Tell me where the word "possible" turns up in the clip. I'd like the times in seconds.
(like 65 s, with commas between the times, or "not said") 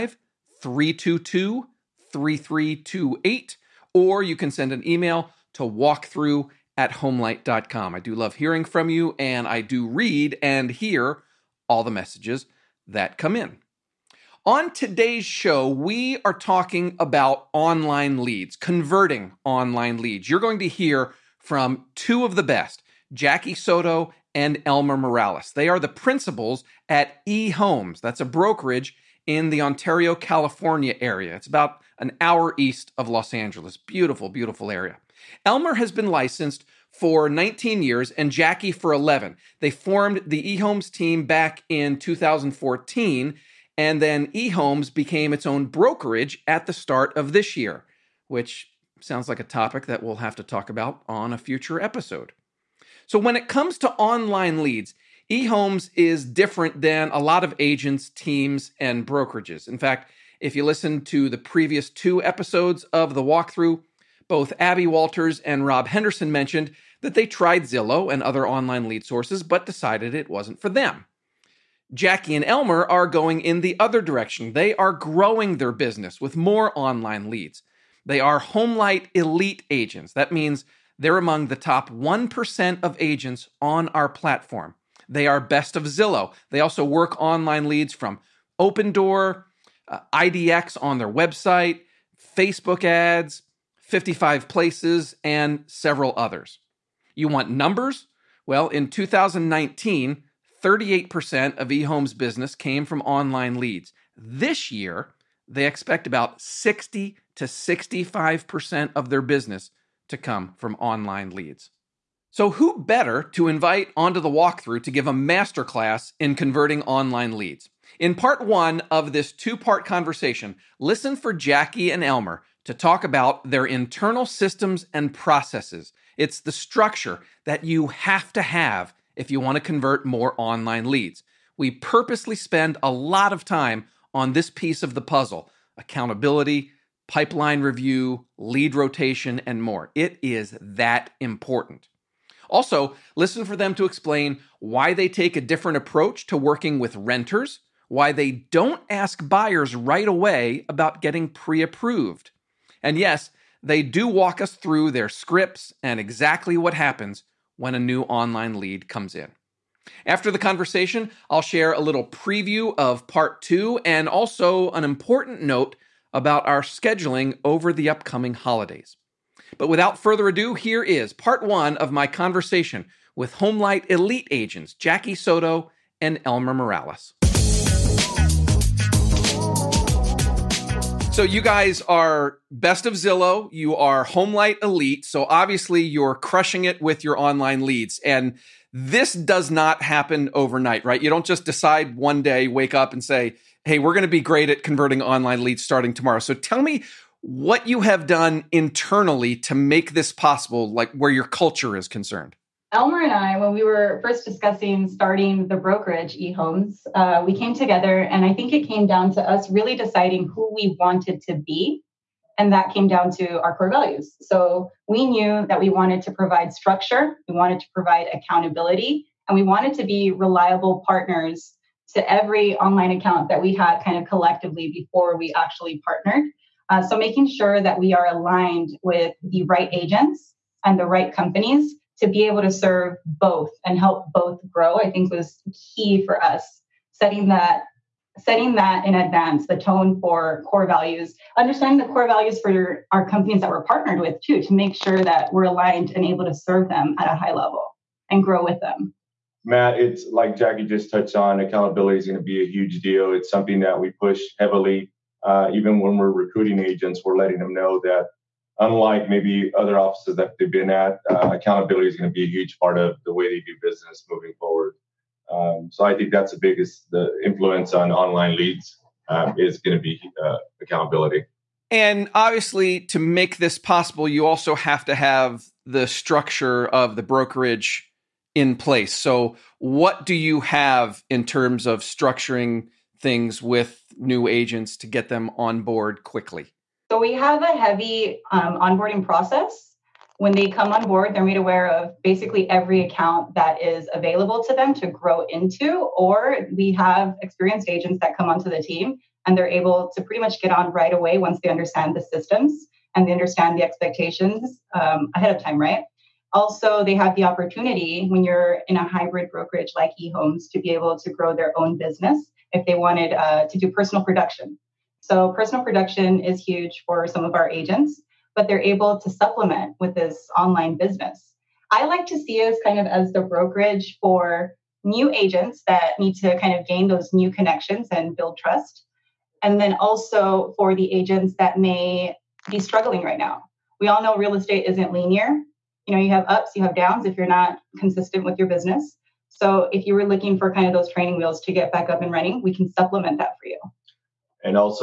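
200 s, 273 s.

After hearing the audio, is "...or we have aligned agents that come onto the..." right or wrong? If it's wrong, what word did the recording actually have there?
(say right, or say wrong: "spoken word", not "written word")
wrong: "experienced", not "aligned".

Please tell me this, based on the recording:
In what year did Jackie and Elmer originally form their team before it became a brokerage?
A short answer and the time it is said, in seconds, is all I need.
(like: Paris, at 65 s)
2014, at 41 s.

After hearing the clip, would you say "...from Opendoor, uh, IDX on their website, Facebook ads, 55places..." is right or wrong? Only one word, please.
right.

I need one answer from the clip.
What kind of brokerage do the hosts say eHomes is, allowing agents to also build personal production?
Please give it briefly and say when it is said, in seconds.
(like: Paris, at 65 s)
Hybrid brokerage, at 308 s.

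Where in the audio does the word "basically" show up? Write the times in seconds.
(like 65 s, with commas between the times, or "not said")
292 s.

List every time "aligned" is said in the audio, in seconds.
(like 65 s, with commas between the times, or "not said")
228 s, 245 s.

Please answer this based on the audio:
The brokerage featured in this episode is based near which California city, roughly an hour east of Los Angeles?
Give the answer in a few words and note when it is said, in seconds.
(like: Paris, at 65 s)
Ontario, at 29 s.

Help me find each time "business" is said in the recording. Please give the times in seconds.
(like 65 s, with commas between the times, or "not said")
75 s, 102 s, 109 s, 263 s, 311 s, 320 s, 338 s.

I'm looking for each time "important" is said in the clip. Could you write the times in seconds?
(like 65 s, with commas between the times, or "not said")
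141 s, 164 s.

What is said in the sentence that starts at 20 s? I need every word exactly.
You're going to hear from two of the best, Jackie Soto and Elmer Morales.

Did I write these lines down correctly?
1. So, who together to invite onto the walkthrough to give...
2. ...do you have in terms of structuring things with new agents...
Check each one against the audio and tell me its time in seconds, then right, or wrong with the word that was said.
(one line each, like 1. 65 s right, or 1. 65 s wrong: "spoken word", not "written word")
1. 112 s wrong: "better", not "together"
2. 280 s right.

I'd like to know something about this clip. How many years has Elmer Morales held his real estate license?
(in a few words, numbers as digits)
19.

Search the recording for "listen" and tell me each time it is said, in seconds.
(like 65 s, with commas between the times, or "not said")
60 s, 120 s, 143 s.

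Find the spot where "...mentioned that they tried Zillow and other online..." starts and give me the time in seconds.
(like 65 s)
66 s.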